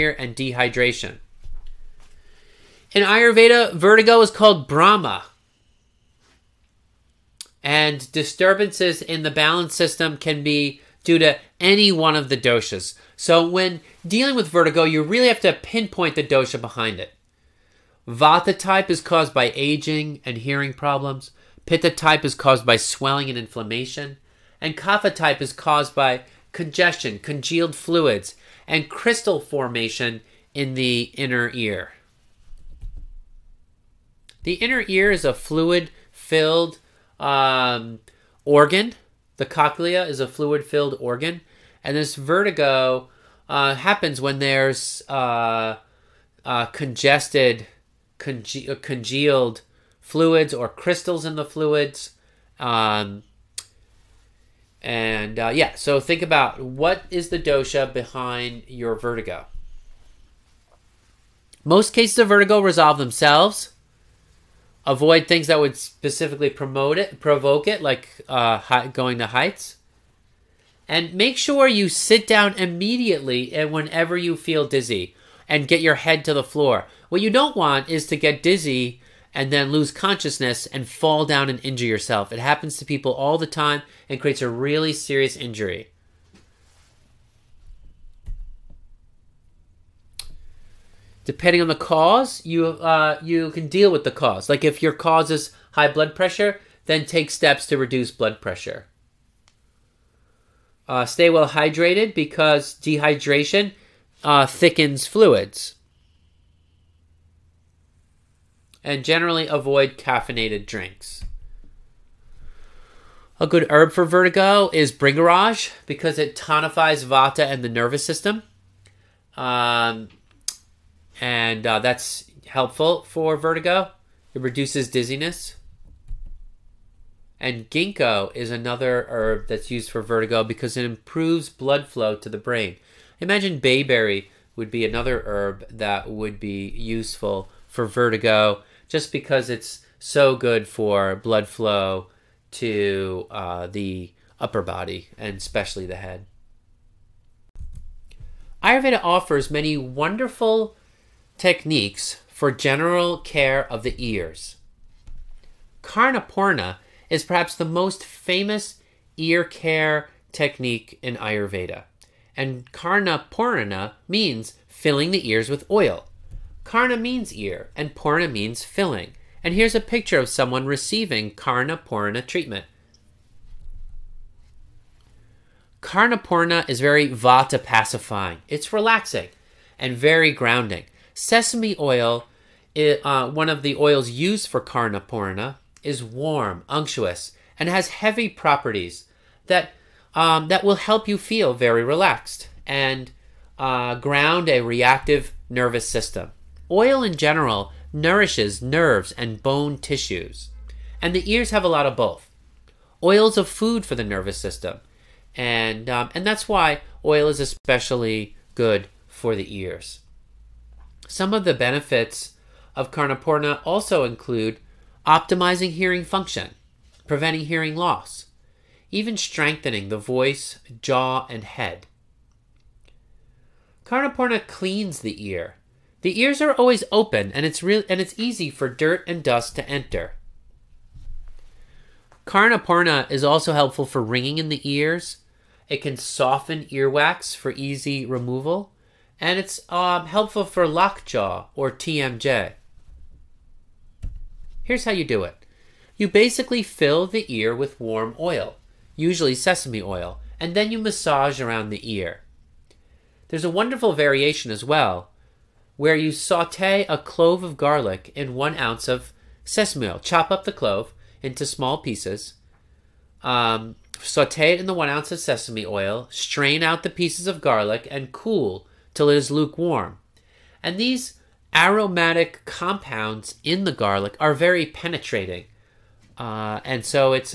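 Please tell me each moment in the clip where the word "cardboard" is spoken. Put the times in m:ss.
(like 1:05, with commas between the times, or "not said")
not said.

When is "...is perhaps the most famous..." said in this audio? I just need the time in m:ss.
2:37.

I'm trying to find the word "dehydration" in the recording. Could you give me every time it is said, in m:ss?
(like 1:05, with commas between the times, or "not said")
0:00, 1:42.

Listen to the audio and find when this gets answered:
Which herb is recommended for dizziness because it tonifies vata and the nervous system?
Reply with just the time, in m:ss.
1:54.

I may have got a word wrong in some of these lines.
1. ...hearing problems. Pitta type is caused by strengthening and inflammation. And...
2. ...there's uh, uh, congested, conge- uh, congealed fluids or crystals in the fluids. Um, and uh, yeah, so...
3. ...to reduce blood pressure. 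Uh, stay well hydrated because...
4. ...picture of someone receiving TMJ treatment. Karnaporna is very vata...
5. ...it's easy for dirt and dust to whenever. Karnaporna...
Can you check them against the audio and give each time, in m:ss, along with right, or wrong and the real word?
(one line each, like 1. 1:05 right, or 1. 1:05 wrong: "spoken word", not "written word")
1. 0:20 wrong: "swelling", not "strengthening"
2. 0:44 right
3. 1:37 right
4. 2:49 wrong: "Karnaporna", not "TMJ"
5. 3:48 wrong: "enter", not "whenever".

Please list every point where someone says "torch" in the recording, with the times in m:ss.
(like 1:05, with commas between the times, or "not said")
not said.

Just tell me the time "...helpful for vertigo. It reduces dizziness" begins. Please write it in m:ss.
2:02.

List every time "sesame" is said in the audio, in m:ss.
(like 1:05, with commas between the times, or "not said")
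3:01, 4:09, 4:19, 4:25.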